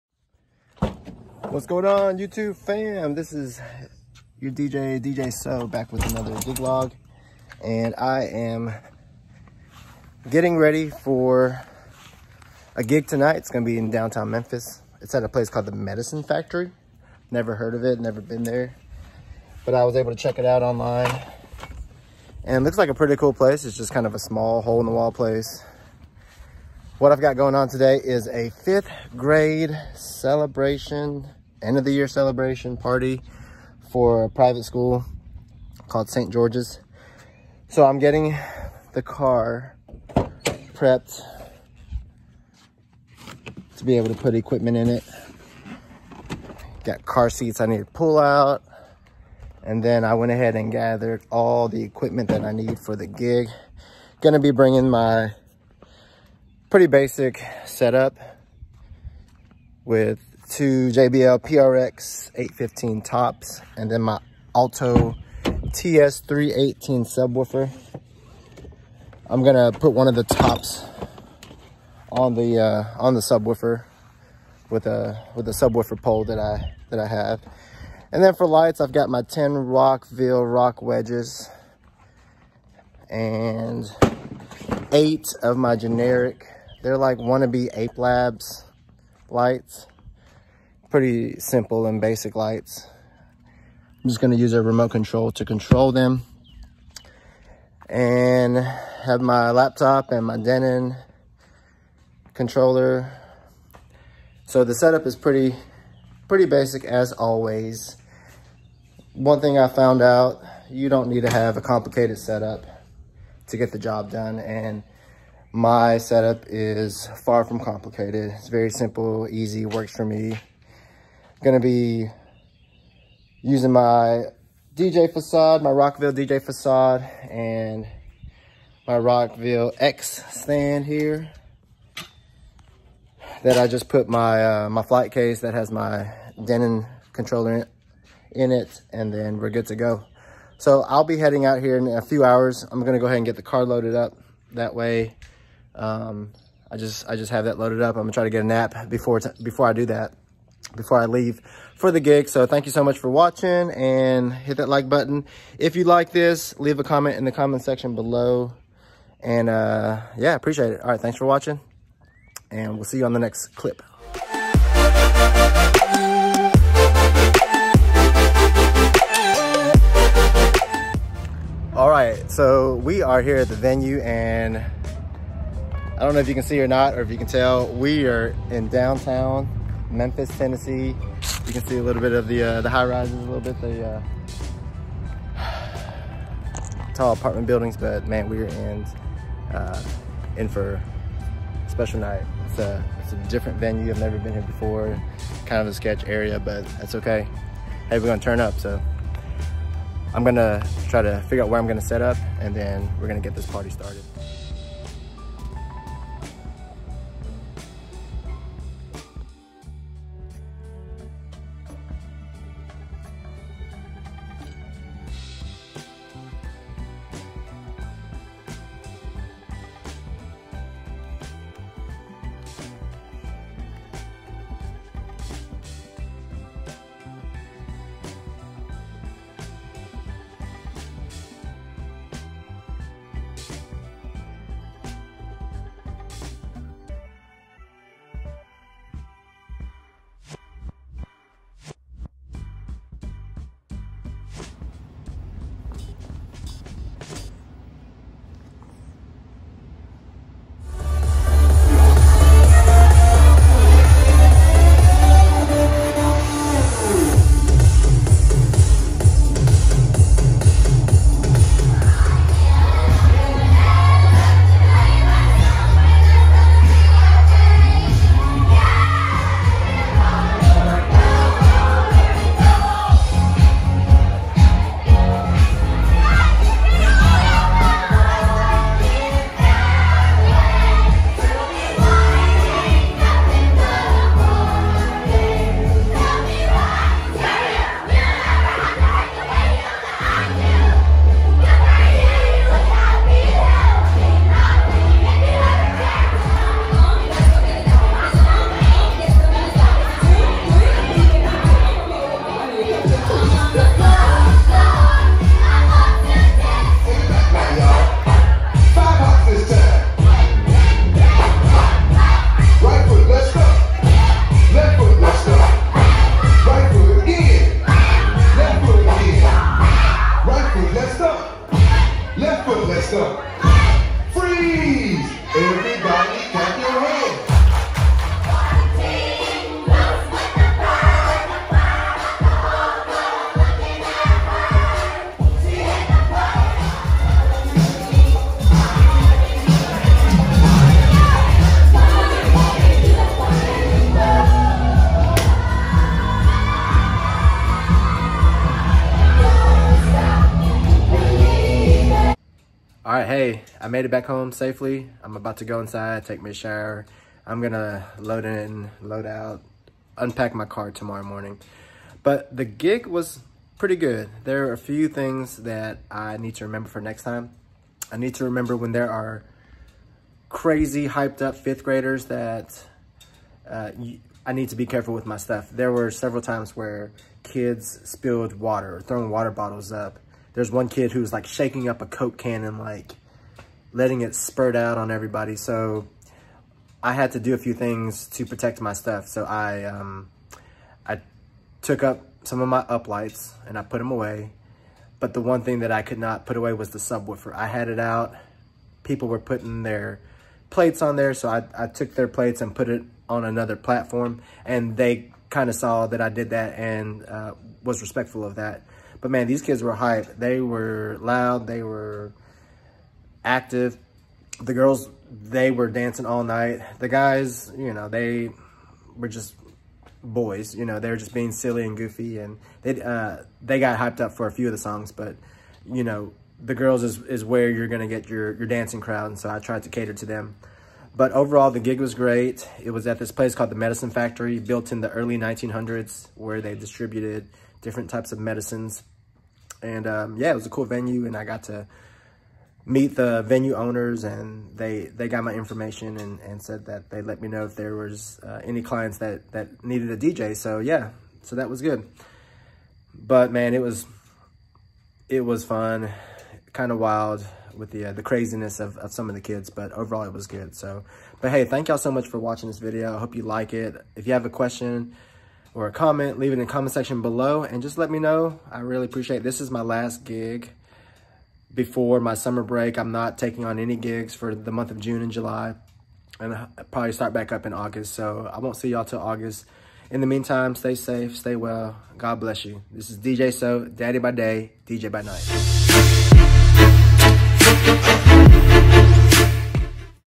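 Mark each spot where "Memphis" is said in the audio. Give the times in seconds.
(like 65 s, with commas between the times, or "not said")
14 s, 179 s.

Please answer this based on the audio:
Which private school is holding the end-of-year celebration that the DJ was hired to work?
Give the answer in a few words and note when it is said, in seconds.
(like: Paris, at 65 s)
St. George's, at 36 s.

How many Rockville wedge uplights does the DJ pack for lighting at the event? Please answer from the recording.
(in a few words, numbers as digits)
10.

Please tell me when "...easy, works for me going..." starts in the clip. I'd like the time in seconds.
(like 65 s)
119 s.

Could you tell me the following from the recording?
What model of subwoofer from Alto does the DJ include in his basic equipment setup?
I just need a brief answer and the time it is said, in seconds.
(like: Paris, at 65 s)
TS318, at 65 s.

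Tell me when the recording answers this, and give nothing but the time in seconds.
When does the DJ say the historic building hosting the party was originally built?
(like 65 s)
434 s.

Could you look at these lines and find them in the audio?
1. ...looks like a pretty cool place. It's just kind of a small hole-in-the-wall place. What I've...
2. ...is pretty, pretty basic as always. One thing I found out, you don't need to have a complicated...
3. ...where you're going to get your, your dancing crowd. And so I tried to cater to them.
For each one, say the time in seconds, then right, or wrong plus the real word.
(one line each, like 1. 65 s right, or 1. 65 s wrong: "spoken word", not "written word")
1. 22 s right
2. 105 s right
3. 427 s right.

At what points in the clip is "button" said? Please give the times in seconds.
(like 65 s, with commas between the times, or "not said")
154 s.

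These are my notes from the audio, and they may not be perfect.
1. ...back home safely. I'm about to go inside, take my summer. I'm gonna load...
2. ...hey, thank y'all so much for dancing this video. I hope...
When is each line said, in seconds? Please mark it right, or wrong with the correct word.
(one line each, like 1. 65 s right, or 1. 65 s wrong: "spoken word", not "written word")
1. 353 s wrong: "shower", not "summer"
2. 461 s wrong: "watching", not "dancing".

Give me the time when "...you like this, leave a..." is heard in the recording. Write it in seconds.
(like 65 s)
155 s.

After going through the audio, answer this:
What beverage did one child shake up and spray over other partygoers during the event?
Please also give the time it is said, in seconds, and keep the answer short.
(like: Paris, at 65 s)
Coke, at 381 s.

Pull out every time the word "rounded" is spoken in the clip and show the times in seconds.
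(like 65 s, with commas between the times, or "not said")
not said.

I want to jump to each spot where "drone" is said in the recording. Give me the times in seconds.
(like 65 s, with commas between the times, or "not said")
not said.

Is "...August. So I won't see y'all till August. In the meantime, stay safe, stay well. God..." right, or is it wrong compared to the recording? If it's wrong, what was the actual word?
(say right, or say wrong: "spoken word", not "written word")
right.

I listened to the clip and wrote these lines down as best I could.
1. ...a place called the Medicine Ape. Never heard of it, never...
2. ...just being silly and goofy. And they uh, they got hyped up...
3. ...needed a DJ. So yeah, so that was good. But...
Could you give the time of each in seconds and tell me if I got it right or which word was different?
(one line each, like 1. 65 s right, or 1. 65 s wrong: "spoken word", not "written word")
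1. 15 s wrong: "Factory", not "Ape"
2. 420 s right
3. 449 s right.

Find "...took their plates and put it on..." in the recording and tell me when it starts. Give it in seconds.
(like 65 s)
401 s.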